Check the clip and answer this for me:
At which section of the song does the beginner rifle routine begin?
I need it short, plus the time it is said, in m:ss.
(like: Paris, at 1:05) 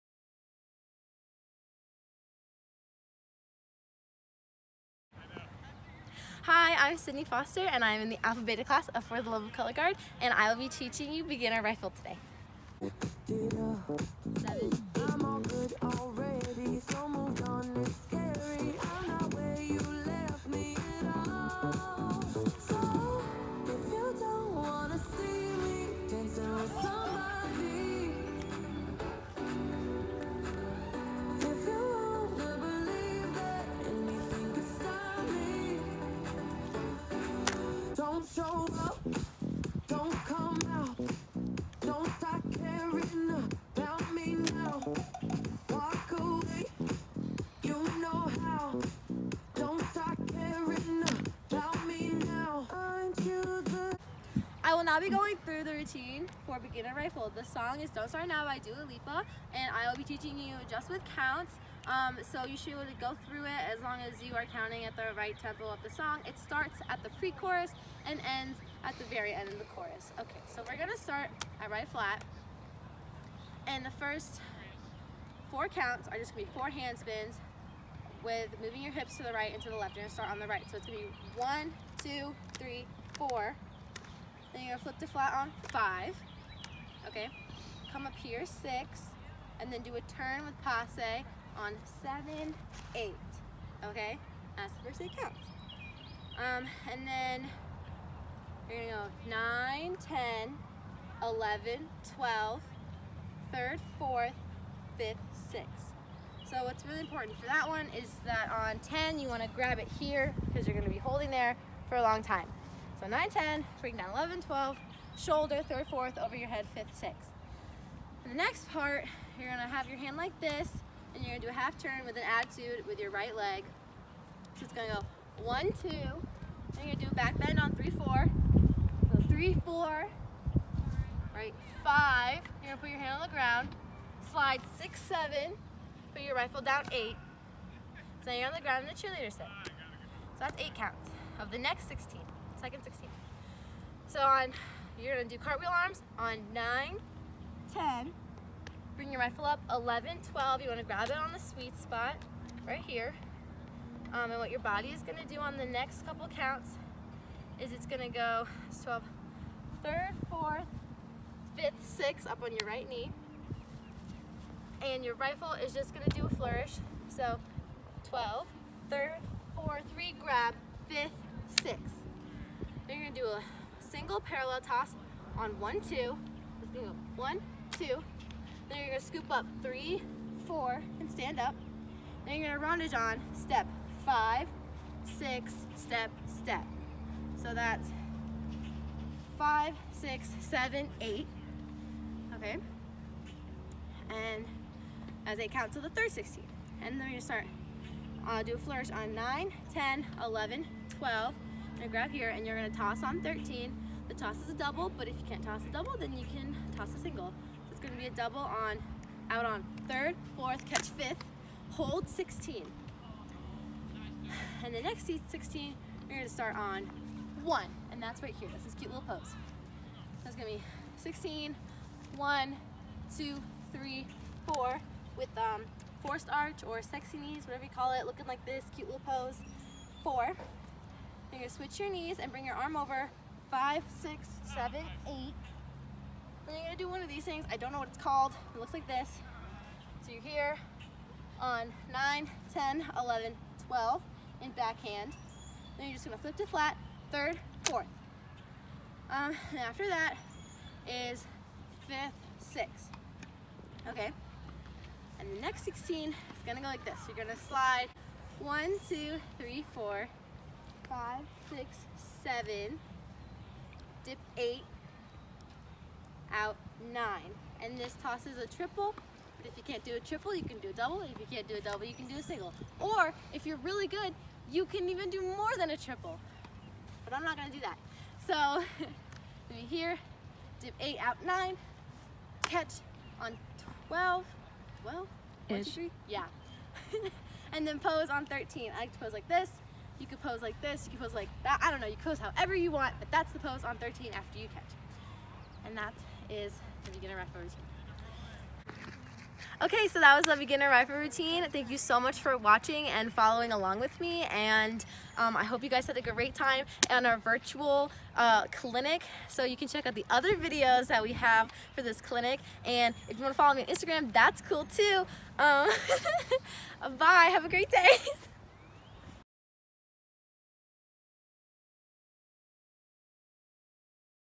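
pre-chorus, at 1:07.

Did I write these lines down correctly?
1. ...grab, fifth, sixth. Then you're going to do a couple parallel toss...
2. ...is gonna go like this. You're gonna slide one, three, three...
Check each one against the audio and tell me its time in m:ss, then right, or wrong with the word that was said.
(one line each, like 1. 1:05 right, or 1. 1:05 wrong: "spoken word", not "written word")
1. 2:50 wrong: "single", not "couple"
2. 4:16 wrong: "two", not "three".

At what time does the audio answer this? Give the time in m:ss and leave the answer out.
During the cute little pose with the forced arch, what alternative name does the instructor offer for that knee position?
3:46.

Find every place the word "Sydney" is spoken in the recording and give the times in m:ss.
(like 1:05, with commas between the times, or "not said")
0:06.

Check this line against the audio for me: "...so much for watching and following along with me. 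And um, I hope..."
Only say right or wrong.
right.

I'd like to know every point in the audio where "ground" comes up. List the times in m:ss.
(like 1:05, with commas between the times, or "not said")
2:13, 2:18.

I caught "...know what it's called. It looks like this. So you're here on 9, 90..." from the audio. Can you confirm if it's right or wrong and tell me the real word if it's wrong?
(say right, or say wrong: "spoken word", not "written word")
wrong: "10", not "90".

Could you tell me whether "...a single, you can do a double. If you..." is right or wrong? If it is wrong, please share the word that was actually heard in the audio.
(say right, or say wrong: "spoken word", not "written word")
wrong: "triple", not "single".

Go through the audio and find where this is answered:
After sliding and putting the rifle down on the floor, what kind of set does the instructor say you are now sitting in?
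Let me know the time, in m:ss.
2:19.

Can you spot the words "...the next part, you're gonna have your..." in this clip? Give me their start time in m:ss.
1:58.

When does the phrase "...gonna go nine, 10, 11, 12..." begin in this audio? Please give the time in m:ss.
1:38.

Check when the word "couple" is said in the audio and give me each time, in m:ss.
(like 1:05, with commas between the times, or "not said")
2:36.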